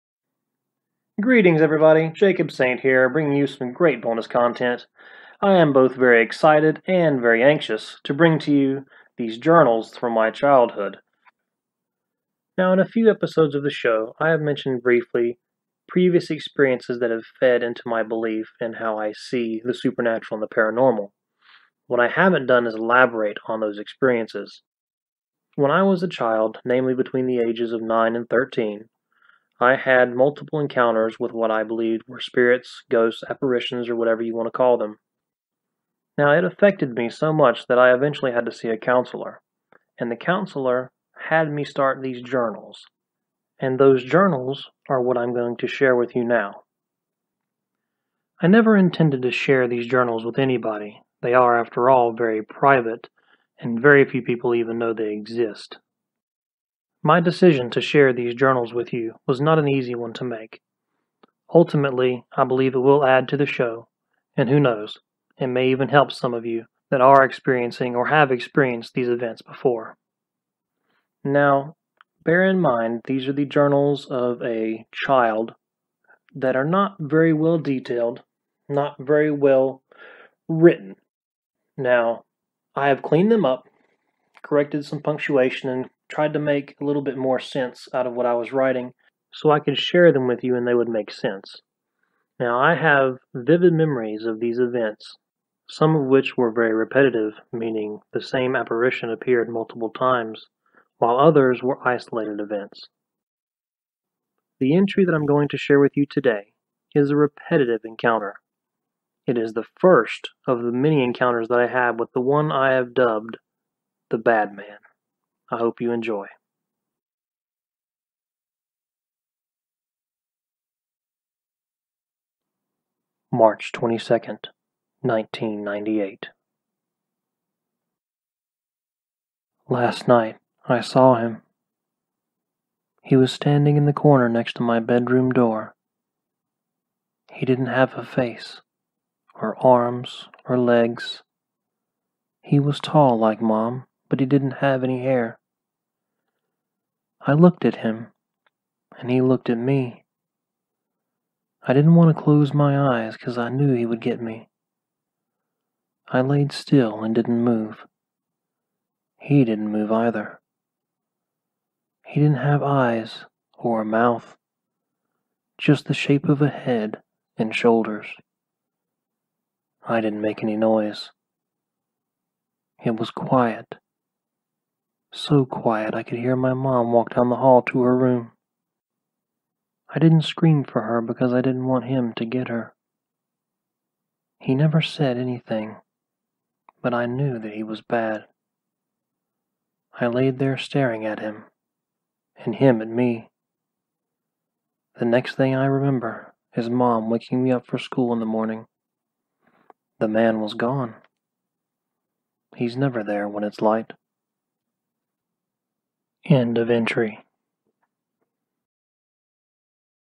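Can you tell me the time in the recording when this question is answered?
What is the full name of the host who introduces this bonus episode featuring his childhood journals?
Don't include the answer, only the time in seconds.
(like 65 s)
2 s.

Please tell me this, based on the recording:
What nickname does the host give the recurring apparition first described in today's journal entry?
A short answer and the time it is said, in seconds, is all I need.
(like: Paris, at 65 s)
the Bad Man, at 114 s.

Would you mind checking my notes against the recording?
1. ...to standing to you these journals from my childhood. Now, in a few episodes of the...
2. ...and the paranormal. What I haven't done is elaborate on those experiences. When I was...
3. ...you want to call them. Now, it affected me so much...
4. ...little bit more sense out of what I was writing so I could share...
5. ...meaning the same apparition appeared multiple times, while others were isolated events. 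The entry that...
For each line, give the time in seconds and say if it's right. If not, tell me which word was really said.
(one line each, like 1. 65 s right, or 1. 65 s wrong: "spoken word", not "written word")
1. 8 s wrong: "bring", not "standing"
2. 20 s right
3. 34 s right
4. 86 s right
5. 97 s right.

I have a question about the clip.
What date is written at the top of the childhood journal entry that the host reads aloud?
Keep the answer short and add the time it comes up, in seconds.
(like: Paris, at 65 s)
March 22nd, 1998, at 123 s.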